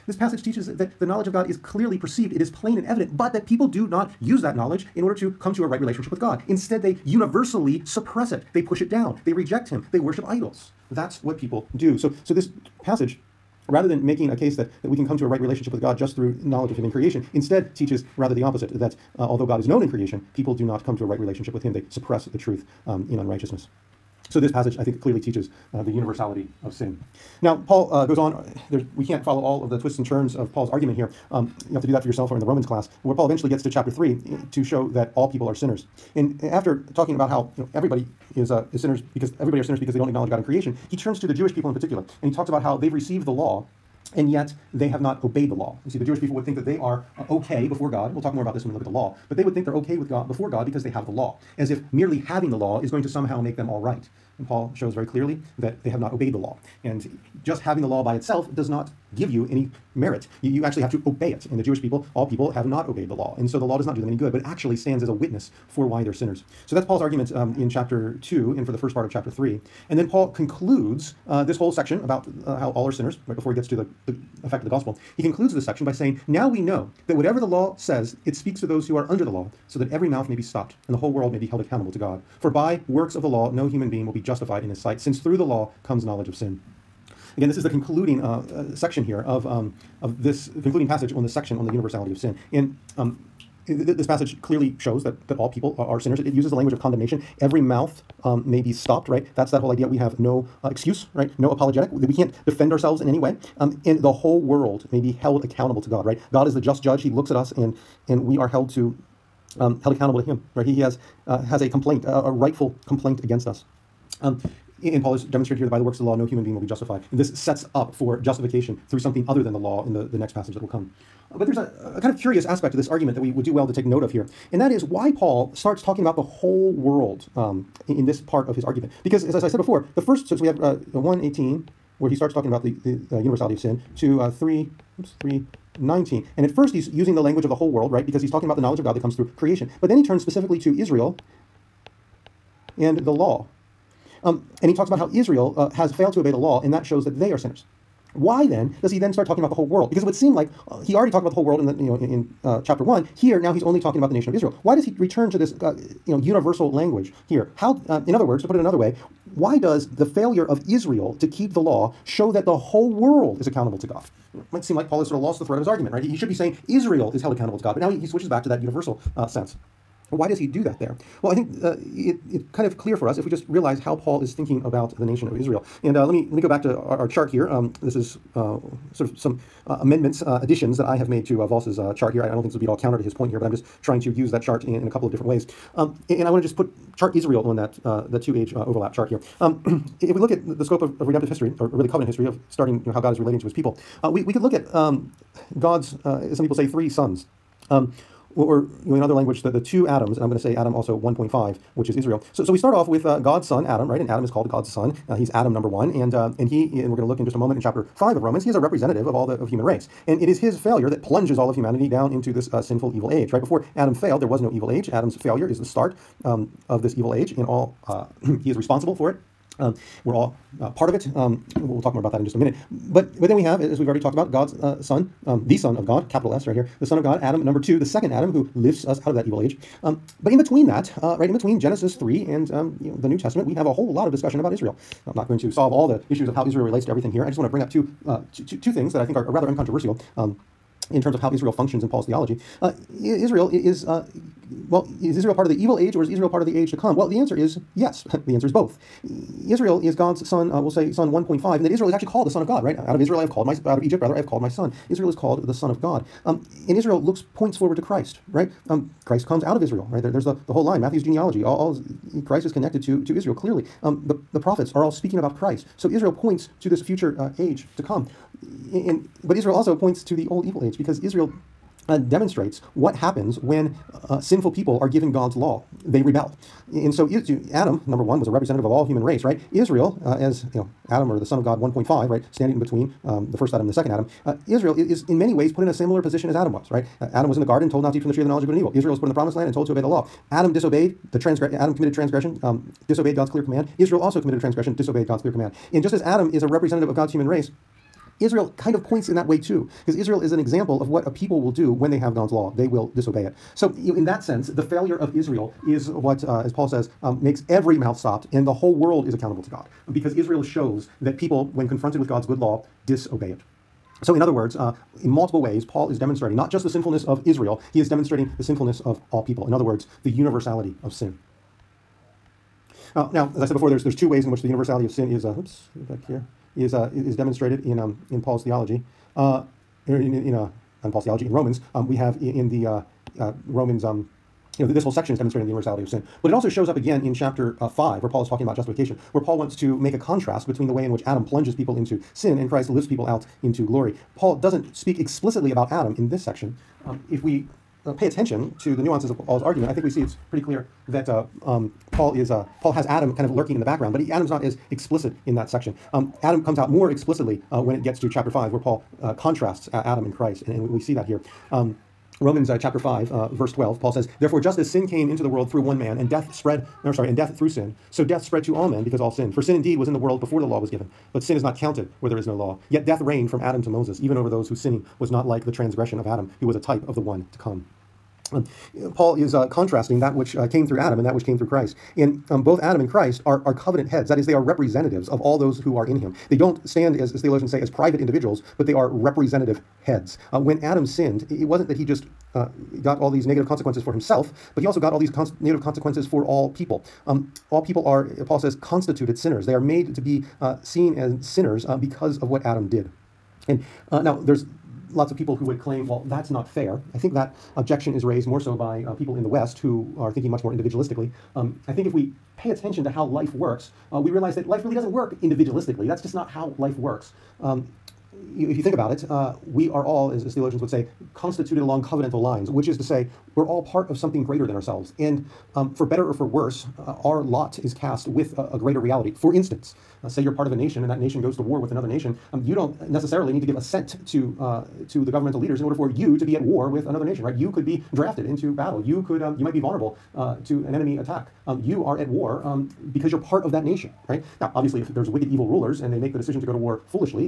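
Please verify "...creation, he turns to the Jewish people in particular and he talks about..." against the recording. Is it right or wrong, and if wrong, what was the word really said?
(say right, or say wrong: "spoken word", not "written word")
right.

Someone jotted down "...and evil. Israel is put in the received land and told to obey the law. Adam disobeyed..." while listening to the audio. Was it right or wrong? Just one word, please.
wrong.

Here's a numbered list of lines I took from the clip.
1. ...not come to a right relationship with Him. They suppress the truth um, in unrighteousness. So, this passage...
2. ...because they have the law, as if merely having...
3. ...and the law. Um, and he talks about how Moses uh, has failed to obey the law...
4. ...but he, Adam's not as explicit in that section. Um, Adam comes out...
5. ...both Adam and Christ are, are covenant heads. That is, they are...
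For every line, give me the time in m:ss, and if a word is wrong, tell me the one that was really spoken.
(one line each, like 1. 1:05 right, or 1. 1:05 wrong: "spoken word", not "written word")
1. 0:20 right
2. 0:50 right
3. 2:22 wrong: "Israel", not "Moses"
4. 5:53 right
5. 6:22 right.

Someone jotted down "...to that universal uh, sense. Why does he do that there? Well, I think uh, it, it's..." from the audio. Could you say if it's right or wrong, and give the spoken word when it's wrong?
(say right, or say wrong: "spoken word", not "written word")
right.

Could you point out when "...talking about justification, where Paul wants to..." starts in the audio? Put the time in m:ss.
5:38.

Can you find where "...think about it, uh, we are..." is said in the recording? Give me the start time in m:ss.
6:58.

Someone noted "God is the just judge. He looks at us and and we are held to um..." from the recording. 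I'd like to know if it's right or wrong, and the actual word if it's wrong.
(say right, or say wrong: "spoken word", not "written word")
right.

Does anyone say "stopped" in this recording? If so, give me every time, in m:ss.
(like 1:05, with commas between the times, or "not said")
1:20, 1:38, 5:07.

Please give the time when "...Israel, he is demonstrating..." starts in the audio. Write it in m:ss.
5:17.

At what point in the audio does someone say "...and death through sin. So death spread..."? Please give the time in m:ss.
6:07.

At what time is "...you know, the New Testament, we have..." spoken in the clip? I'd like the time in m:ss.
3:52.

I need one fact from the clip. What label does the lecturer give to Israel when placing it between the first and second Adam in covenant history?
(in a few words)
Adam 1.5.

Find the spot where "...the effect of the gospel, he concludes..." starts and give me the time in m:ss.
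1:14.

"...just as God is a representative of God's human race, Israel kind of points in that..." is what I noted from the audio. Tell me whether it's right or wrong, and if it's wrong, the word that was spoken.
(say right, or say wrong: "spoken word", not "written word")
wrong: "Adam", not "God".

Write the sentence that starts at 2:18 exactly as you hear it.
Because he's talking about the knowledge of God that comes through creation.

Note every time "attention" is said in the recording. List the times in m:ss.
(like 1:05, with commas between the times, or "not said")
5:48, 6:52.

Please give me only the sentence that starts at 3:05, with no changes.
Um, and, and, I want to just put chart Israel on that uh, the two age uh, overlap chart here.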